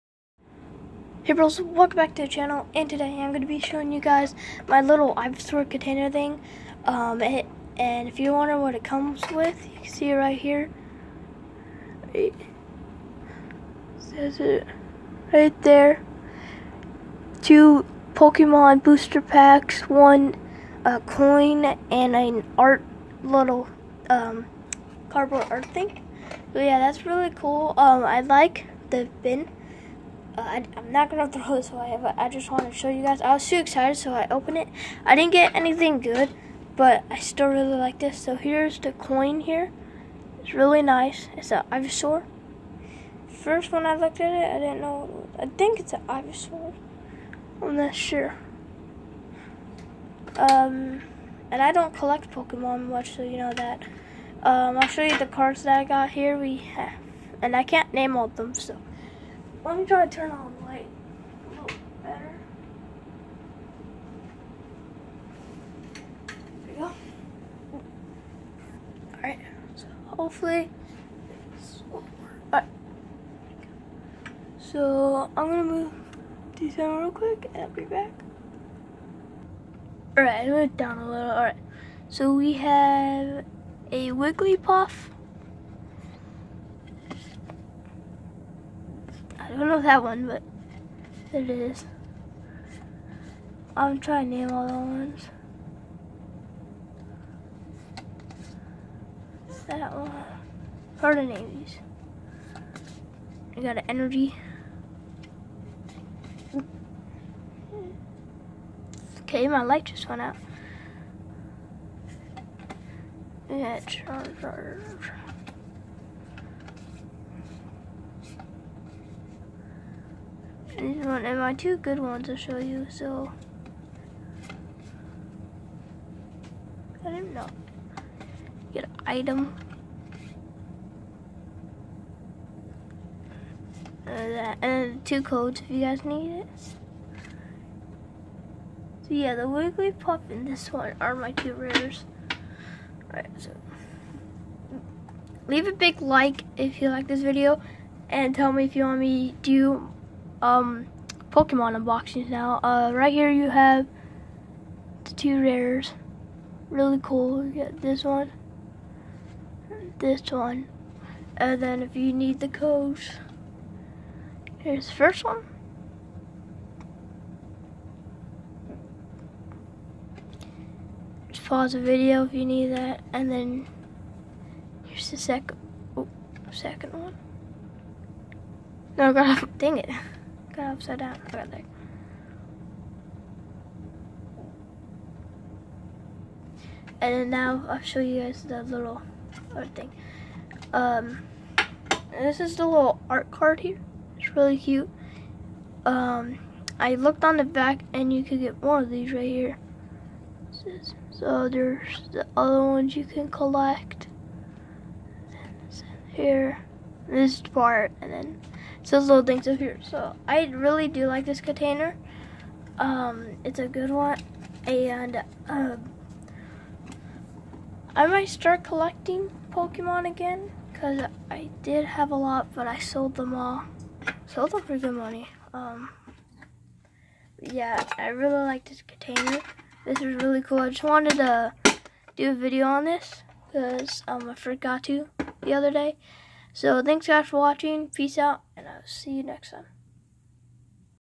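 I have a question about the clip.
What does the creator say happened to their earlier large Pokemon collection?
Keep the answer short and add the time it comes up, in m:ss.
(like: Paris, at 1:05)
Sold them all, at 3:42.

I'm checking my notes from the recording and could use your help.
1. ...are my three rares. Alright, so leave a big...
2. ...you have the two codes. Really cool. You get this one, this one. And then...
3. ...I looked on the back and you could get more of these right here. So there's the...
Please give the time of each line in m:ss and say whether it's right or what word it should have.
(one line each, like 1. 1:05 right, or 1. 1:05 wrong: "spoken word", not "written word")
1. 2:20 wrong: "two", not "three"
2. 2:33 wrong: "rares", not "codes"
3. 3:16 right.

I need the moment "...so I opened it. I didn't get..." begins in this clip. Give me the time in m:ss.
0:33.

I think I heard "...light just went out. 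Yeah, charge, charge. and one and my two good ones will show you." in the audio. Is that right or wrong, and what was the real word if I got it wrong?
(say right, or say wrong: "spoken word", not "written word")
right.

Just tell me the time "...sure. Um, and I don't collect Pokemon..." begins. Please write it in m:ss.
0:47.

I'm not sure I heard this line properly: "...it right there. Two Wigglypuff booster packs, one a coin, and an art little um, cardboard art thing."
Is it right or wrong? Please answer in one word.
wrong.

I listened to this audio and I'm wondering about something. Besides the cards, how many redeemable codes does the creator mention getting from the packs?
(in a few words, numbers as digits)
2.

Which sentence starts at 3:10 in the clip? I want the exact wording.
Um, this is the little art card here.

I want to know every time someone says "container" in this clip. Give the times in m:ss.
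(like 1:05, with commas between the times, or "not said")
0:05, 3:31, 3:48.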